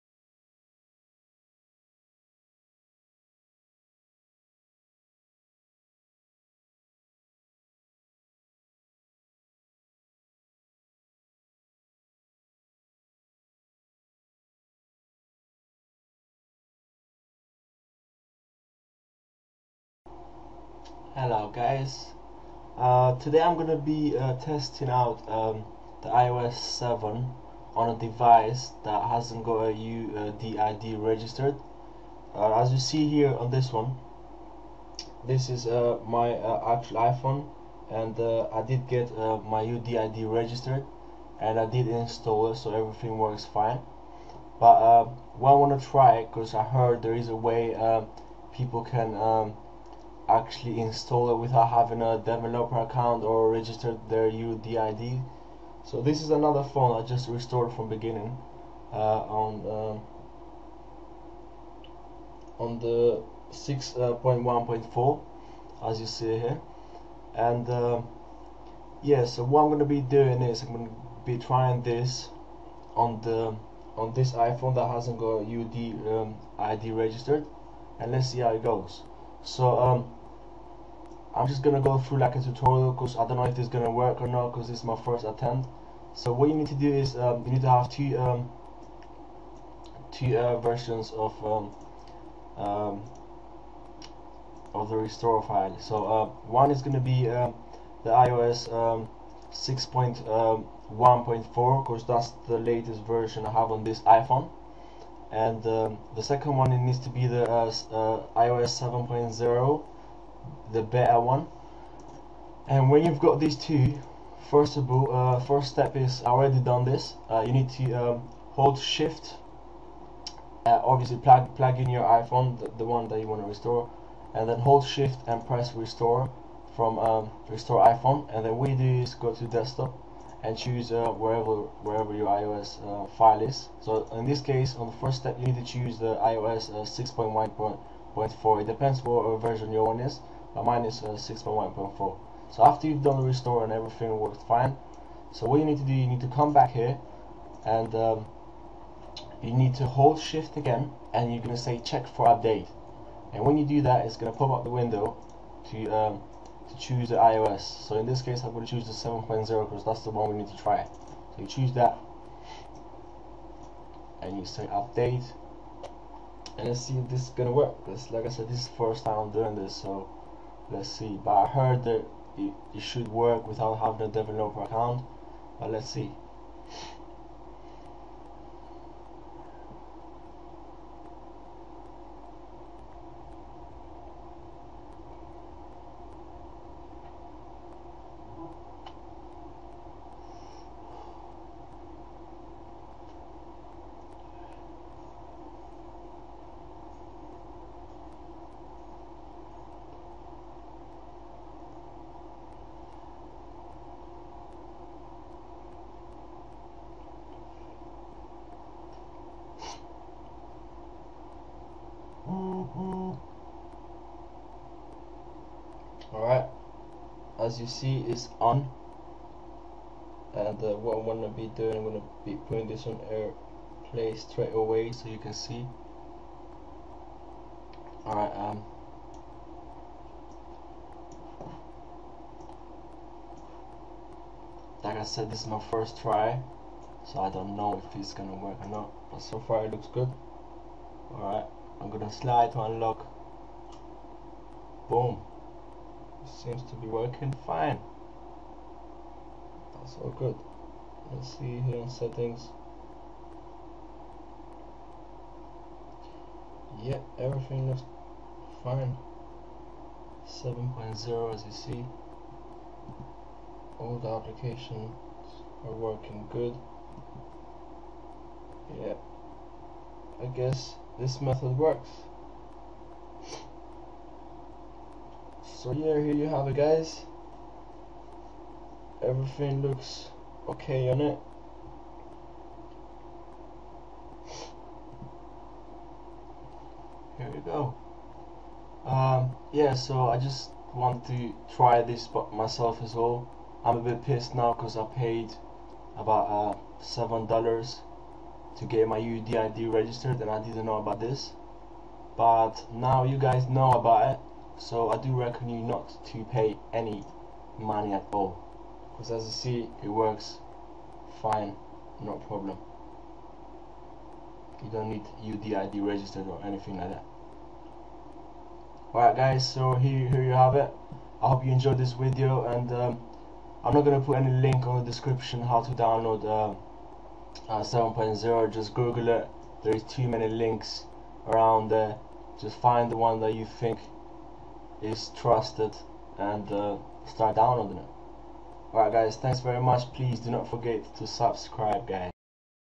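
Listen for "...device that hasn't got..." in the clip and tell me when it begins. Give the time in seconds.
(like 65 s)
27 s.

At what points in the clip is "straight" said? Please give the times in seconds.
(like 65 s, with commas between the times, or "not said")
224 s.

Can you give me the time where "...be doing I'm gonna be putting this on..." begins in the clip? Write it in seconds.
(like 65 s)
221 s.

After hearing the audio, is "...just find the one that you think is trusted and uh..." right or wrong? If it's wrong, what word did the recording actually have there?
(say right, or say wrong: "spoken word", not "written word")
right.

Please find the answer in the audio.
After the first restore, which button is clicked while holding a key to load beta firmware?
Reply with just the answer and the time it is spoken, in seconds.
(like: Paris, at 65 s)
Check for update, at 151 s.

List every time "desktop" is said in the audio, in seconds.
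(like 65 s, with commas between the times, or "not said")
129 s.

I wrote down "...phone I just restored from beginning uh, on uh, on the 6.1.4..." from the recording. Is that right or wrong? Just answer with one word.
right.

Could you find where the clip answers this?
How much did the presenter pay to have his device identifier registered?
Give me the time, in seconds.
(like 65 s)
296 s.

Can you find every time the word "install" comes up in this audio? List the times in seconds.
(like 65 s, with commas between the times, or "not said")
41 s, 50 s.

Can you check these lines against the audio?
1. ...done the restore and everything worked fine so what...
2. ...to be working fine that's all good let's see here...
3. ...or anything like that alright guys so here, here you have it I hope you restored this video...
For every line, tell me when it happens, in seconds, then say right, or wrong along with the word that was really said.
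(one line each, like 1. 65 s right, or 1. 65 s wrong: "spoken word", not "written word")
1. 143 s right
2. 246 s right
3. 316 s wrong: "enjoyed", not "restored".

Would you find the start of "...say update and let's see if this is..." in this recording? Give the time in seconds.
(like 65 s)
164 s.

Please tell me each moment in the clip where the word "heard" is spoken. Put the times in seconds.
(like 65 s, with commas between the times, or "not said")
46 s, 171 s.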